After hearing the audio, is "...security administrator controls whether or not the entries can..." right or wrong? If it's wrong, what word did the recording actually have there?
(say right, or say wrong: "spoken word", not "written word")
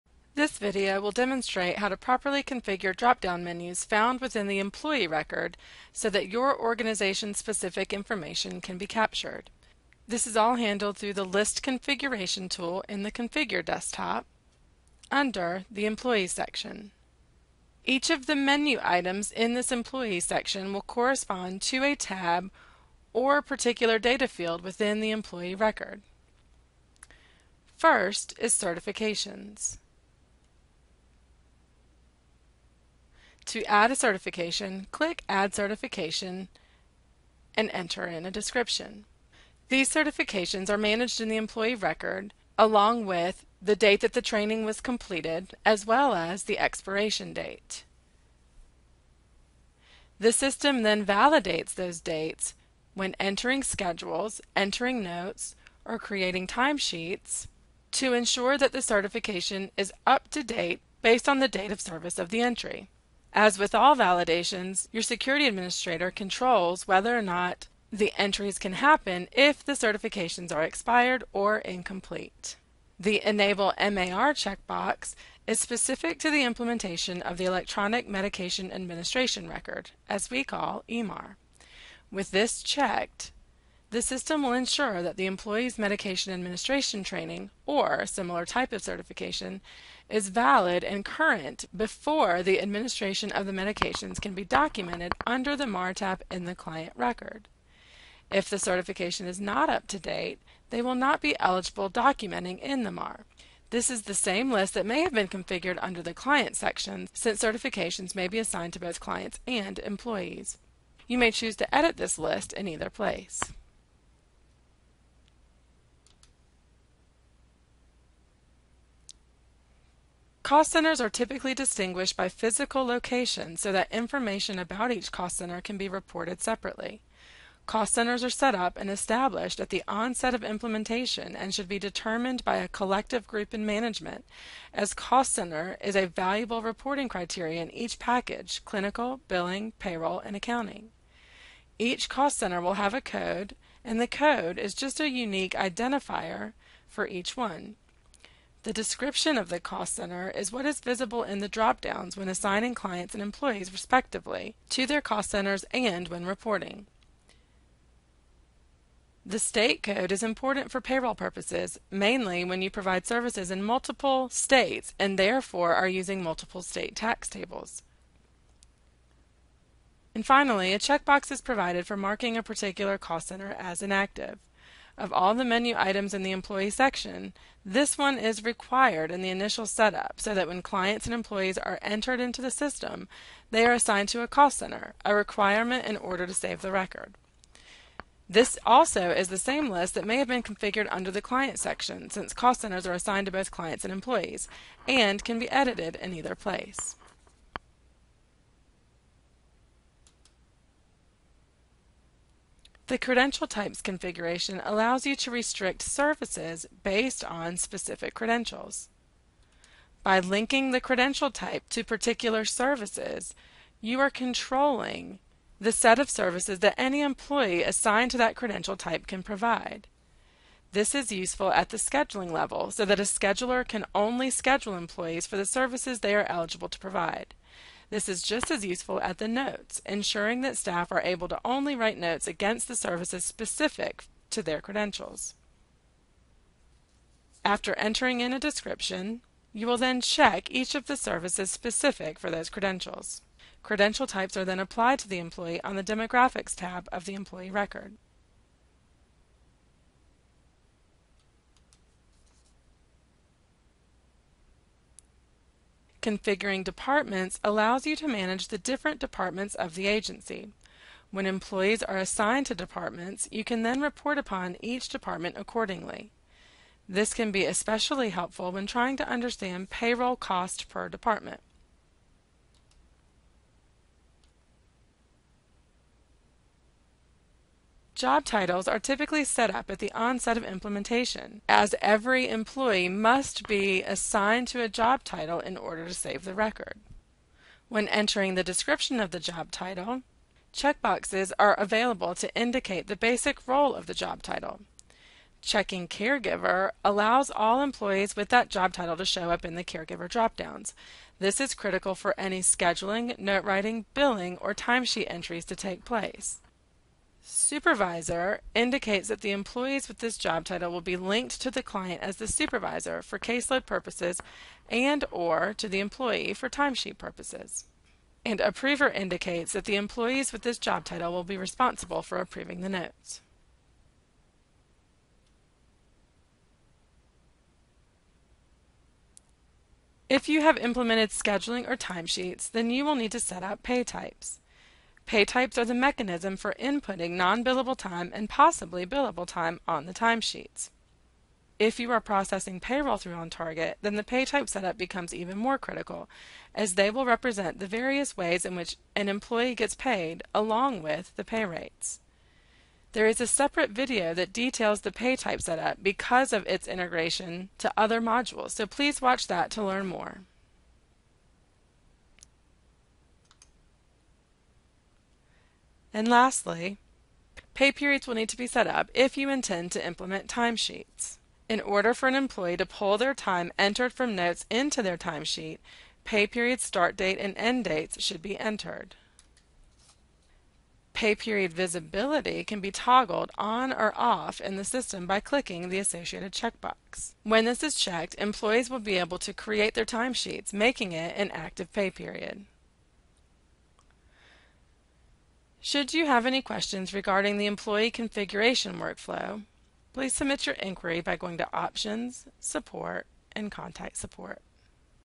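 right.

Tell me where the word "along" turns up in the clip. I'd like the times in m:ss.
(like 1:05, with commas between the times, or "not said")
0:42, 5:50.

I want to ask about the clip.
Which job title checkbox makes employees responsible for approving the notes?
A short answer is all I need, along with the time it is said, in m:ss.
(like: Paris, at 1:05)
Approver, at 5:18.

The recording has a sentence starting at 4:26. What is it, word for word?
This can be especially helpful when trying to understand payroll cost per department.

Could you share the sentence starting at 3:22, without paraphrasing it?
The credential types configuration allows you to restrict services based on specific credentials.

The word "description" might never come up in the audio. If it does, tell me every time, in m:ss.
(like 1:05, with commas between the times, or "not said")
0:38, 2:28, 3:58, 4:48.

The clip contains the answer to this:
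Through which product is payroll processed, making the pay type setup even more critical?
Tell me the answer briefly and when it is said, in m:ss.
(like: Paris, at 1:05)
OnTarget, at 5:43.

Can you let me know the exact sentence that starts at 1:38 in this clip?
If the certification is not up to date, they will not be eligible documenting in the MAR.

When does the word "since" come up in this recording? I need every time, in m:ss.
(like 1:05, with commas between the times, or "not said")
1:47, 3:12.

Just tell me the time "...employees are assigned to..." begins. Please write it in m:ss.
4:21.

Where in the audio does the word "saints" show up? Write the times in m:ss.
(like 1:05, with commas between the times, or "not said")
not said.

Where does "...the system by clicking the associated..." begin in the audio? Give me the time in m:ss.
6:24.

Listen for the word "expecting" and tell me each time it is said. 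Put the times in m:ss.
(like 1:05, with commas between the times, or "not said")
not said.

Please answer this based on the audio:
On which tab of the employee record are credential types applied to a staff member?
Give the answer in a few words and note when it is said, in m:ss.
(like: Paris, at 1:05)
Demographics, at 4:05.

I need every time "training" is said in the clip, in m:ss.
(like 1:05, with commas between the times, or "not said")
0:44, 1:27.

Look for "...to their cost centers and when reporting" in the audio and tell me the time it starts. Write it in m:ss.
2:34.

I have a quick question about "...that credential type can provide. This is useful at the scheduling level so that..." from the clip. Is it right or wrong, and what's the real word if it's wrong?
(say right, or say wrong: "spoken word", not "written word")
right.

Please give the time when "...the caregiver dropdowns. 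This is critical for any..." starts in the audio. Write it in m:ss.
4:59.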